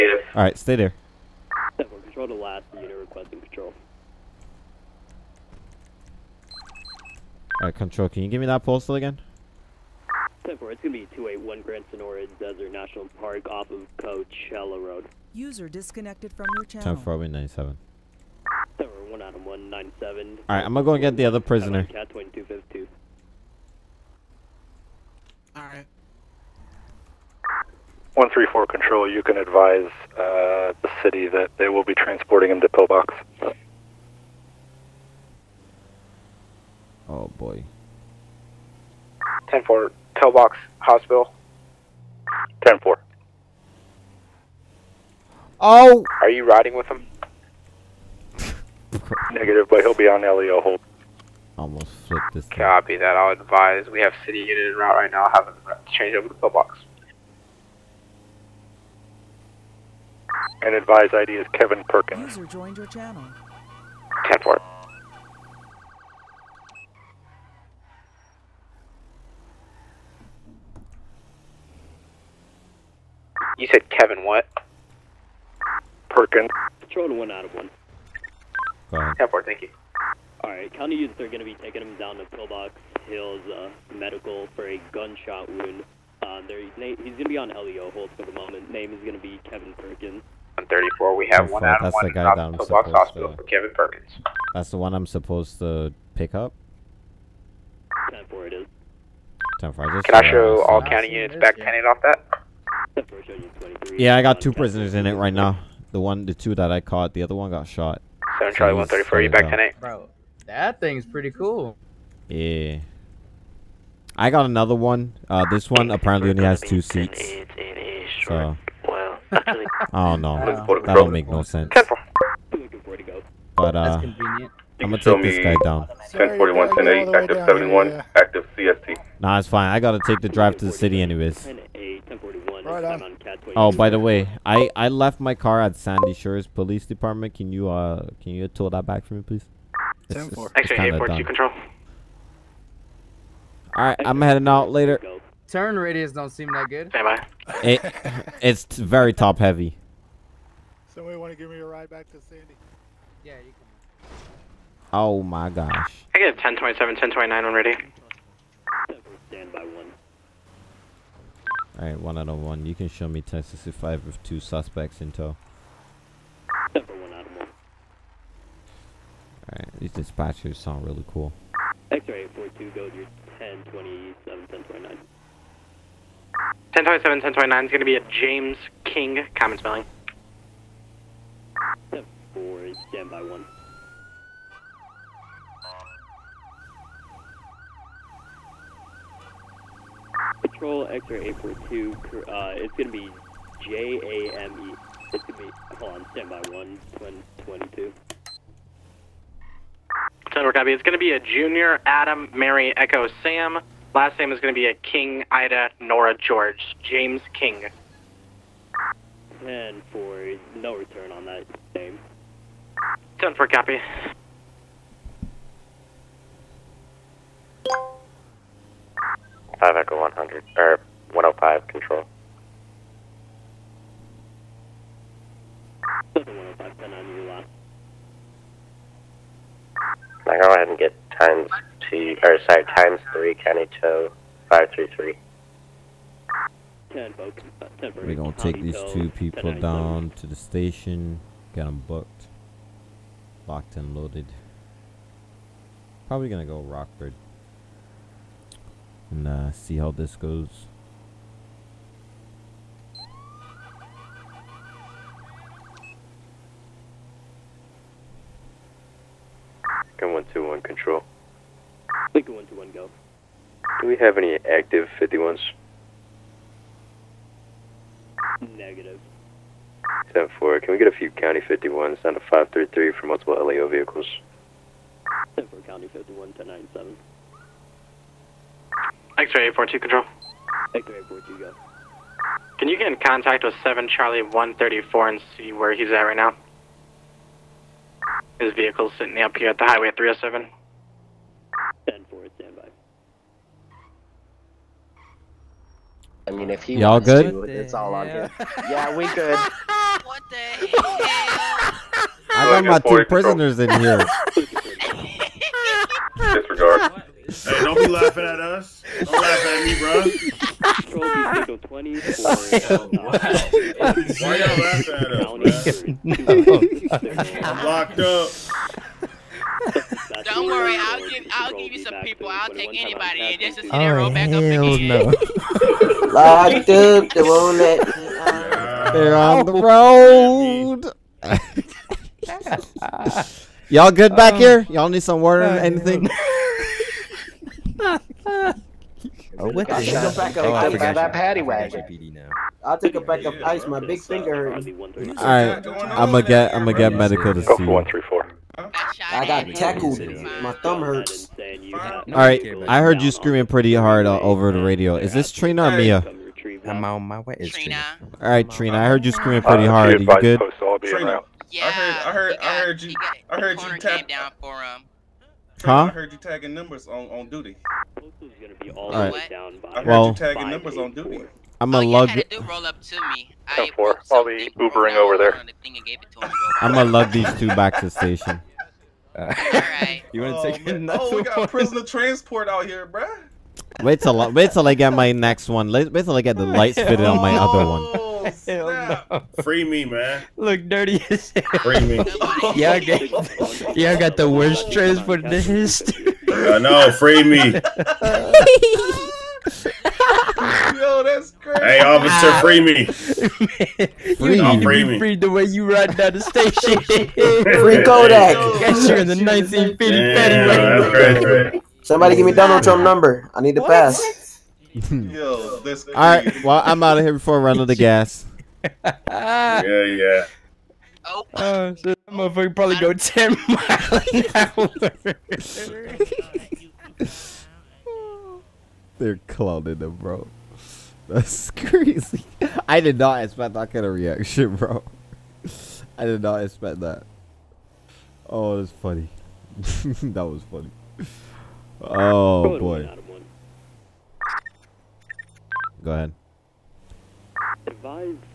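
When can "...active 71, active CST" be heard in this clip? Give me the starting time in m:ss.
2:07.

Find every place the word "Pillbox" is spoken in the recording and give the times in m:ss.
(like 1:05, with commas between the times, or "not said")
0:32, 0:40, 1:22, 1:32.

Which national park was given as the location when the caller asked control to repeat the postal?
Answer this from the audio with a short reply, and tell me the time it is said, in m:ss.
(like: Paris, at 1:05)
Grand Senora Desert National Park, at 0:11.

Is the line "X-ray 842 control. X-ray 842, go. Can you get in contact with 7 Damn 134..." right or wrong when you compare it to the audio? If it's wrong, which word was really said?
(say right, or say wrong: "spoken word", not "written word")
wrong: "Charlie", not "Damn".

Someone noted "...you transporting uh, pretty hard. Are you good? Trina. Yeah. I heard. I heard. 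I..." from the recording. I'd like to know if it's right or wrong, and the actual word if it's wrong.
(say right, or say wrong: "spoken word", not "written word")
wrong: "screaming", not "transporting".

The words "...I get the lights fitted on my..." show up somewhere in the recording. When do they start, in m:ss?
6:26.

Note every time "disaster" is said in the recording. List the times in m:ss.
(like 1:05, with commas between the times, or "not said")
not said.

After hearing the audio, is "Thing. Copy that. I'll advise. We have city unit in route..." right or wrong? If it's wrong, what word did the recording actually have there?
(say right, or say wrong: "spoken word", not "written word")
right.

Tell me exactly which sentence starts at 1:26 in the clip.
Uh, he's going to be on LEO hold for the moment.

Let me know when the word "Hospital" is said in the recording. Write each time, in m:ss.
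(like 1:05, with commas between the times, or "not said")
0:40, 1:32.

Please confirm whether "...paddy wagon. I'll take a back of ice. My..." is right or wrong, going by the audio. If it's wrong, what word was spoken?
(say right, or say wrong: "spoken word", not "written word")
right.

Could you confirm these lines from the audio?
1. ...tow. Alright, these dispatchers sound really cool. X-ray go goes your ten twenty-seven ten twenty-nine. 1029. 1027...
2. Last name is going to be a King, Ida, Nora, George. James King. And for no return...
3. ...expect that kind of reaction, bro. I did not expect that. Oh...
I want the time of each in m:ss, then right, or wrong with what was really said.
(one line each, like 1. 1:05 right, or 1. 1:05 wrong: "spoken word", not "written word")
1. 2:45 right
2. 3:23 right
3. 7:13 right.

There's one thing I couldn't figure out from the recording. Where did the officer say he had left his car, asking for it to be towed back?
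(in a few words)
Sandy Shores Police Department.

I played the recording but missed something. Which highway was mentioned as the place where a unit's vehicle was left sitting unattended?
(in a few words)
Highway 307.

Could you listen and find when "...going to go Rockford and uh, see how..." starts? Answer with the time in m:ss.
4:06.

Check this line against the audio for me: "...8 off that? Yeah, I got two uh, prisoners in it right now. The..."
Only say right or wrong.
right.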